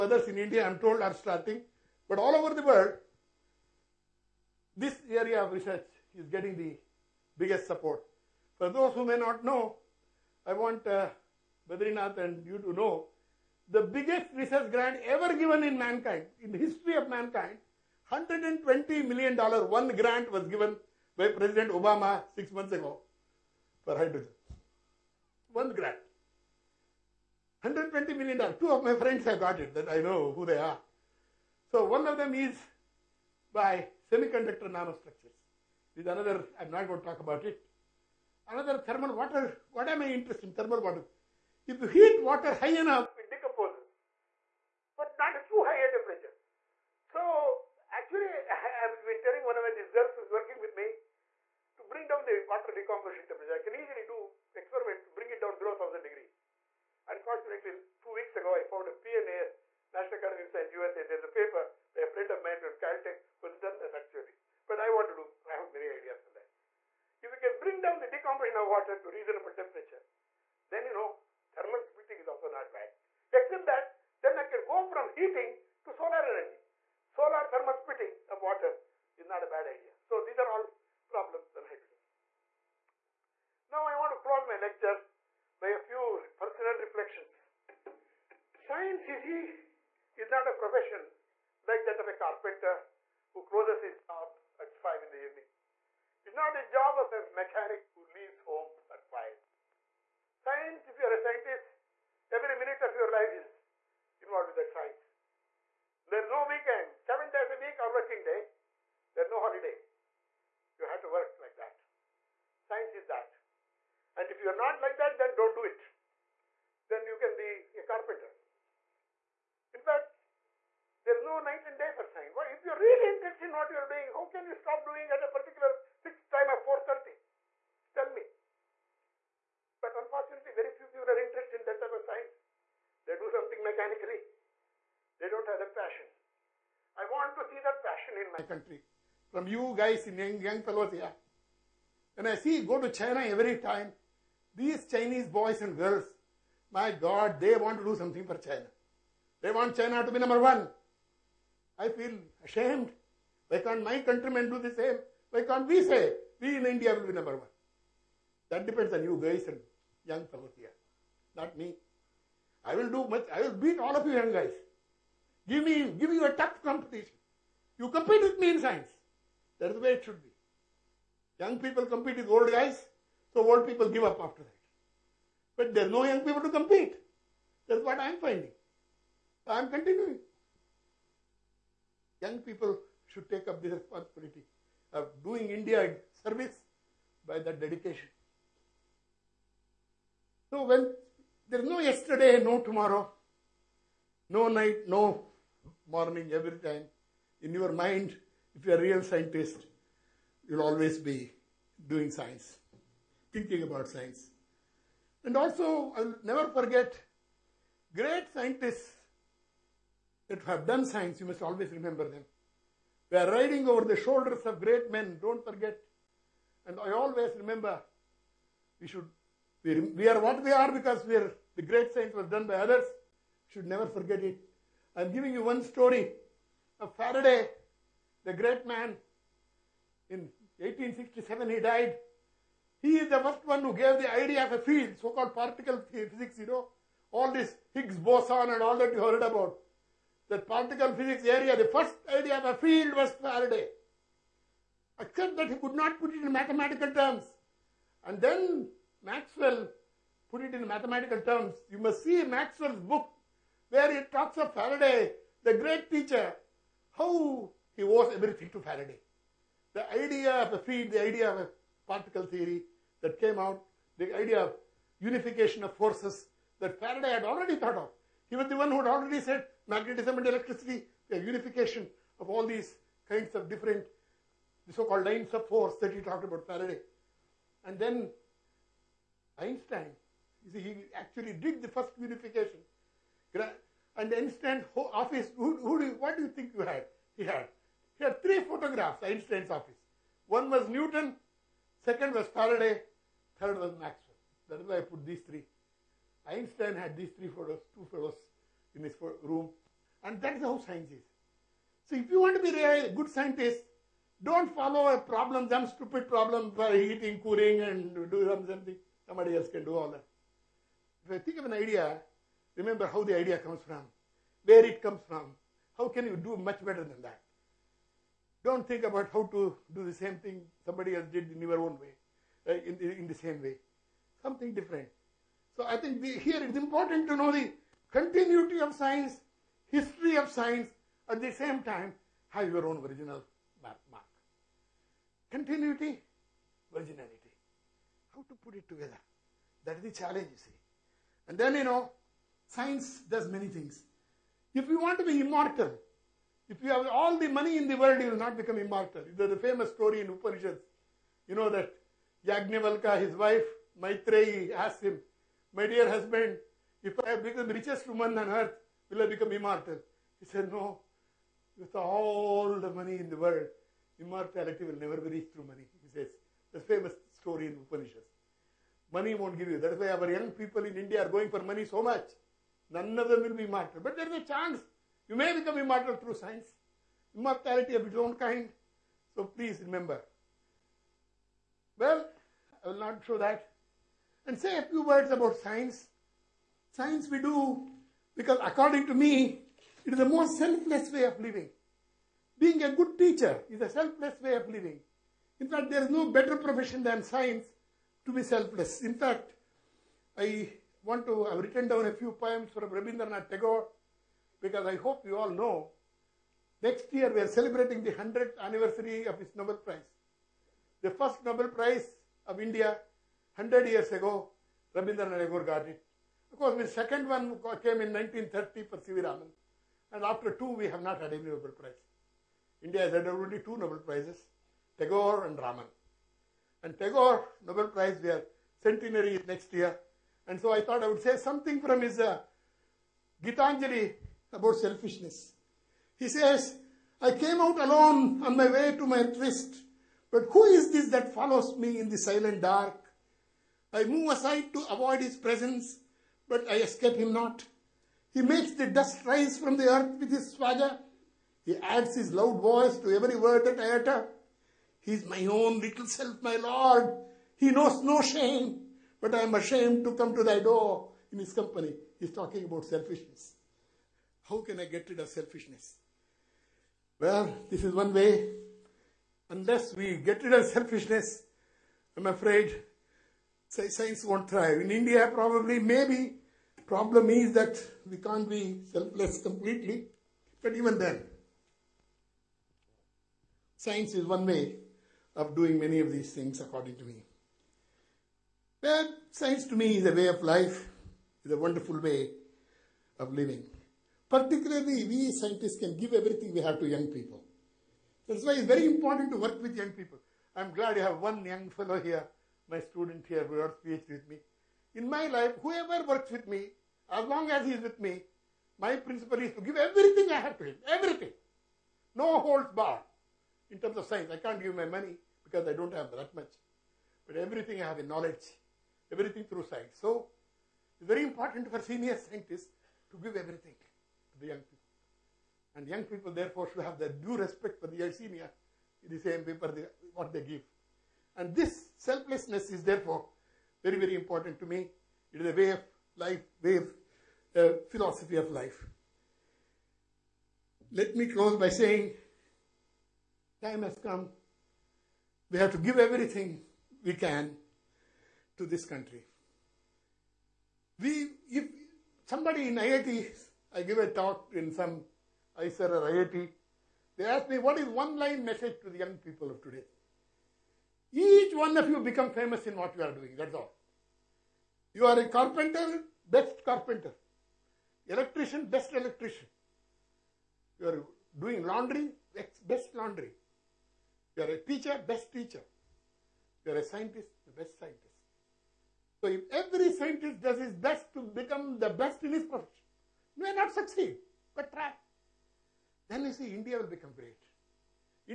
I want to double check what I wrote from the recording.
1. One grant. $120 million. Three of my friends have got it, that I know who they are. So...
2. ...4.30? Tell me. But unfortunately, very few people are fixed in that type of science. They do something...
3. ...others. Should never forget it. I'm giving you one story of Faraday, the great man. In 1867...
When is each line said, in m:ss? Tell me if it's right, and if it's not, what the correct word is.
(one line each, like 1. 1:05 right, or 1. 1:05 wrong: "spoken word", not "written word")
1. 0:25 wrong: "Two", not "Three"
2. 2:06 wrong: "interested", not "fixed"
3. 3:42 right.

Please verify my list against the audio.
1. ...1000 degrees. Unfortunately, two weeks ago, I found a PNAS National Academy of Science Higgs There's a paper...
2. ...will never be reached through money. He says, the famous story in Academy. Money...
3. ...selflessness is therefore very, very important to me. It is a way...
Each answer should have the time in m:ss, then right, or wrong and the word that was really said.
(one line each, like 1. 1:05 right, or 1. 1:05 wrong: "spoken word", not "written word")
1. 0:55 wrong: "USA", not "Higgs"
2. 6:04 wrong: "Upanishads", not "Academy"
3. 8:51 right.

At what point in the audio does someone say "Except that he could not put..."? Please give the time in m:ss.
4:04.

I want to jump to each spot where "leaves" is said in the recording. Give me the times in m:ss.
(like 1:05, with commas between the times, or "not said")
1:38.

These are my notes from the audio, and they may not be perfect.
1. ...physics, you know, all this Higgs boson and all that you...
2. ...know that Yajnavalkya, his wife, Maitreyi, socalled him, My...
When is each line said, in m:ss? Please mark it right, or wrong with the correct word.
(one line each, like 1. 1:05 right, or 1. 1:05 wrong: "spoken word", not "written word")
1. 3:55 right
2. 5:51 wrong: "asked", not "socalled".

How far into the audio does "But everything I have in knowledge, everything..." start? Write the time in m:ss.
8:37.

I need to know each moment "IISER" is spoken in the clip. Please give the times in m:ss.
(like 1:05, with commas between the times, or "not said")
9:15.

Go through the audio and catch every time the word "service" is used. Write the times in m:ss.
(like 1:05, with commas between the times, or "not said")
3:06.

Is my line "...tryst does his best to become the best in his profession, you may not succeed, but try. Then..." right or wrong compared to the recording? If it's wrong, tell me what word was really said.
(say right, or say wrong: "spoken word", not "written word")
wrong: "scientist", not "tryst".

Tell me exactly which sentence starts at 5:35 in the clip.
Continuity, originality, How to put it together?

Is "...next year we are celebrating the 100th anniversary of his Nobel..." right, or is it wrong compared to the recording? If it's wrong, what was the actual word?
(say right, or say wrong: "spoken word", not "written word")
right.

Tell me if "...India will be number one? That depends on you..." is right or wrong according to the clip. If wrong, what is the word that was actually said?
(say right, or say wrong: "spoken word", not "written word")
right.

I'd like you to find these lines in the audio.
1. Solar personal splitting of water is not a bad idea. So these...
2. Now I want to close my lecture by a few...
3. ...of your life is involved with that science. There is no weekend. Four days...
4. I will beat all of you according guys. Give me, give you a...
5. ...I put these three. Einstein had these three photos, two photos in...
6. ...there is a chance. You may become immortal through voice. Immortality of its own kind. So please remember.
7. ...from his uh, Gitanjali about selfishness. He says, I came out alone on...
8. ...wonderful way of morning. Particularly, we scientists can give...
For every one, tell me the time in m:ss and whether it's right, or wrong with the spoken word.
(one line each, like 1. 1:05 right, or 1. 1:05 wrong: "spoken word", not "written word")
1. 1:17 wrong: "thermal", not "personal"
2. 1:23 right
3. 1:42 wrong: "Seven", not "Four"
4. 2:43 wrong: "young", not "according"
5. 4:54 right
6. 6:13 wrong: "science", not "voice"
7. 7:11 right
8. 8:11 wrong: "living", not "morning".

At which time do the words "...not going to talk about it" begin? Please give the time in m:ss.
0:36.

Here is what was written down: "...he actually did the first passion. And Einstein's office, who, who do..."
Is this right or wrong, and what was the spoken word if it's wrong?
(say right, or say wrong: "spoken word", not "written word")
wrong: "unification", not "passion".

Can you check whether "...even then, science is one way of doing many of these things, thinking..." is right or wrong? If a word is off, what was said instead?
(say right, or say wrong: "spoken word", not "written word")
wrong: "according", not "thinking".